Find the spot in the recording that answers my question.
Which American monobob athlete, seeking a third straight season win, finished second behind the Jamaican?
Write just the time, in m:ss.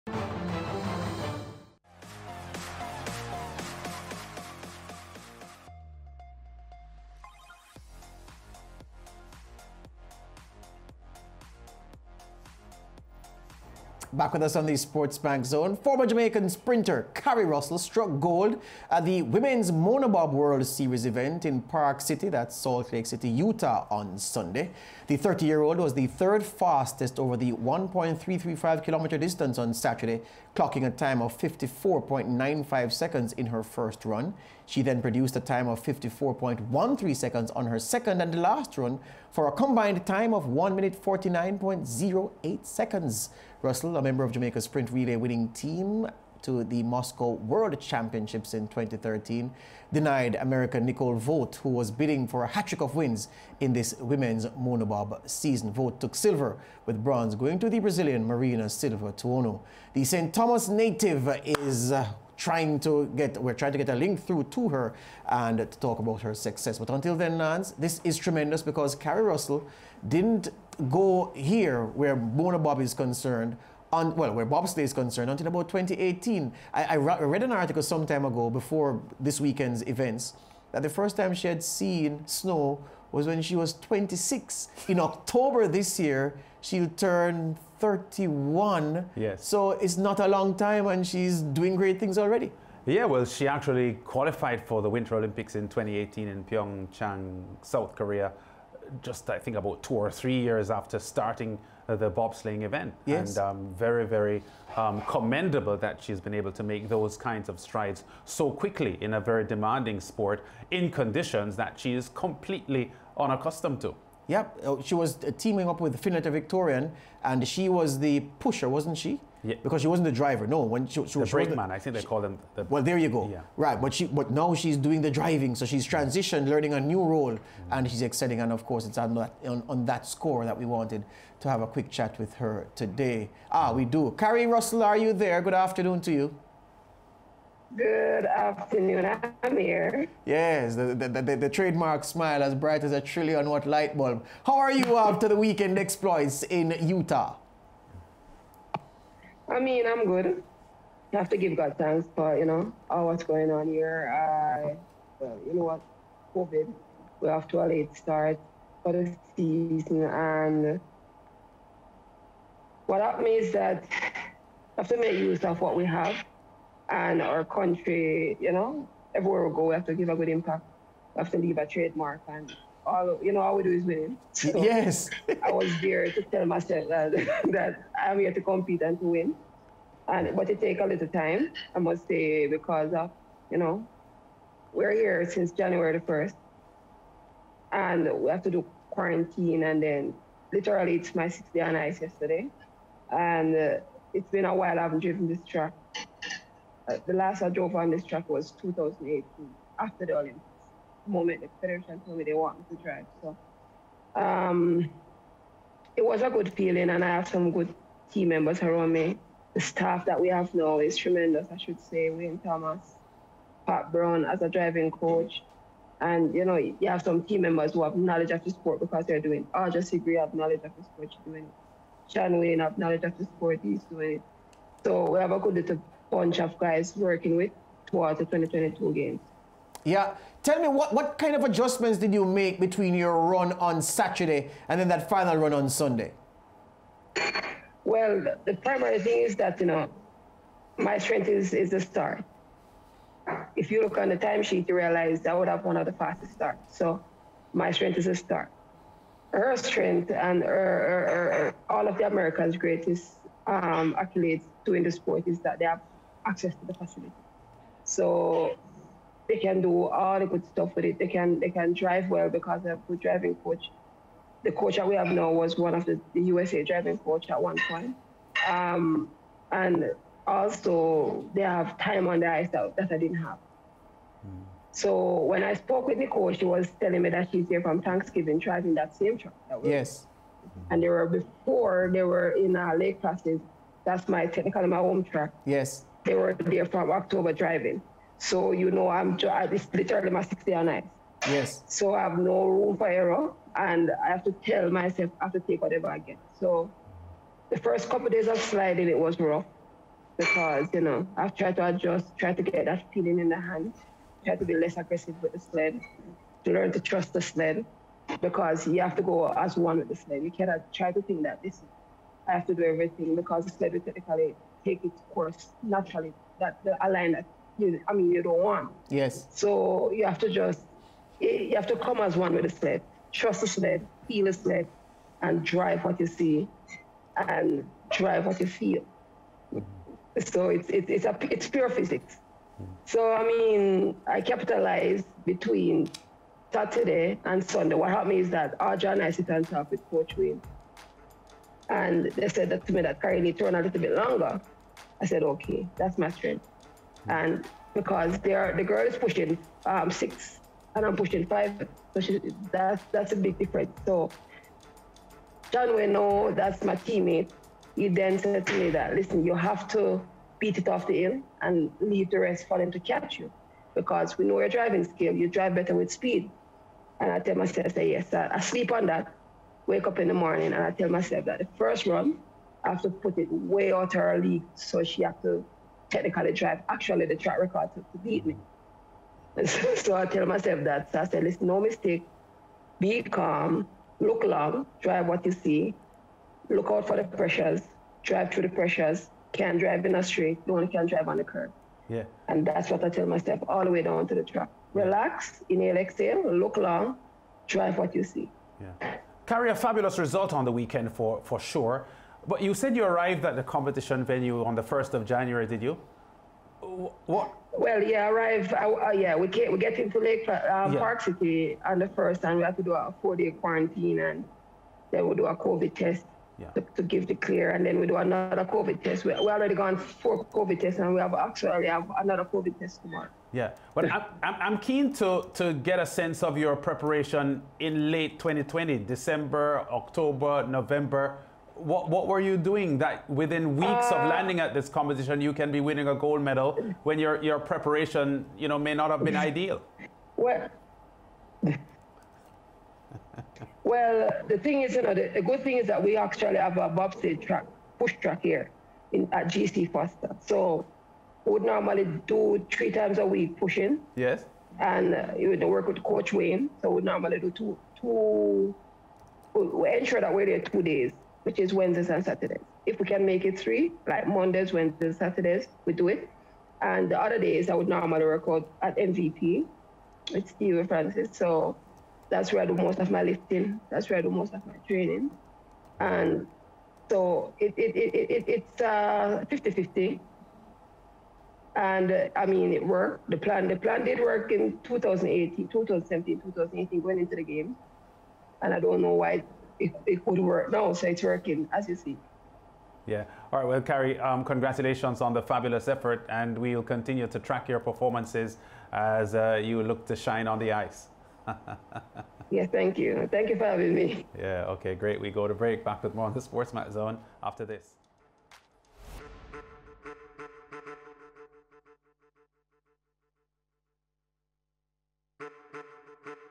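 0:50.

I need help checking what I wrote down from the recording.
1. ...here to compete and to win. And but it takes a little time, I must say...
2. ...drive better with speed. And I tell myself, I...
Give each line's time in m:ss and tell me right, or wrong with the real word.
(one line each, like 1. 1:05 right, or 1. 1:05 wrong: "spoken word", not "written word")
1. 2:58 right
2. 6:05 right.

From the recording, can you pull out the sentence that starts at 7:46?
And the other days, I would normally record at MVP with Steve Francis.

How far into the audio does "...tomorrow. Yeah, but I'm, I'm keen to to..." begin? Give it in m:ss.
7:02.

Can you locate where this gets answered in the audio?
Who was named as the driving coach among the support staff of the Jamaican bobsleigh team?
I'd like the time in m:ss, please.
3:33.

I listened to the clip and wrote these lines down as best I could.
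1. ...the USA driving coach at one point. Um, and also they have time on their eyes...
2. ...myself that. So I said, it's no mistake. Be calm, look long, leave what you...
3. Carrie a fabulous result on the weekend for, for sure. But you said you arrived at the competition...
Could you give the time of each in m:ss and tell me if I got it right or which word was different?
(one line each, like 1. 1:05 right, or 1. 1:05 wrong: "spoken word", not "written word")
1. 4:26 right
2. 6:20 wrong: "drive", not "leave"
3. 6:39 right.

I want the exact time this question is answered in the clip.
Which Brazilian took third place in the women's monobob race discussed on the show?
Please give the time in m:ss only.
0:58.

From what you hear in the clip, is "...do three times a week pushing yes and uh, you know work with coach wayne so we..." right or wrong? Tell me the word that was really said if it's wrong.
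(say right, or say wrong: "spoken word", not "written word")
right.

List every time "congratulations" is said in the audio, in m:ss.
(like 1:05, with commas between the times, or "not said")
8:14.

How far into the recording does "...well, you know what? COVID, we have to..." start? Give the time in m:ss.
2:35.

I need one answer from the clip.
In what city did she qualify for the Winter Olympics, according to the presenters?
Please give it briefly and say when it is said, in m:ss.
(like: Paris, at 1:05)
Pyeongchang, at 1:36.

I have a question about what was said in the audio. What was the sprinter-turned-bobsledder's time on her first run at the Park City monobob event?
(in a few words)
54.95 seconds.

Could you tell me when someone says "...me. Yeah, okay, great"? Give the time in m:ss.
8:23.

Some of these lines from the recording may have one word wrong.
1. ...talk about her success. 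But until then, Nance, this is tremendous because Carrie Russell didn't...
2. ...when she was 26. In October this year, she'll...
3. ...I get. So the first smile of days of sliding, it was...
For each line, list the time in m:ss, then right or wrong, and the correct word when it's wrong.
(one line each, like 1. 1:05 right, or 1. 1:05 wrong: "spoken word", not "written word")
1. 1:05 right
2. 1:23 right
3. 4:55 wrong: "couple", not "smile".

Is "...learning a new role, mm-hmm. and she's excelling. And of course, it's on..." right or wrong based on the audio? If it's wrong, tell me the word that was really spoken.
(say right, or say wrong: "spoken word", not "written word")
right.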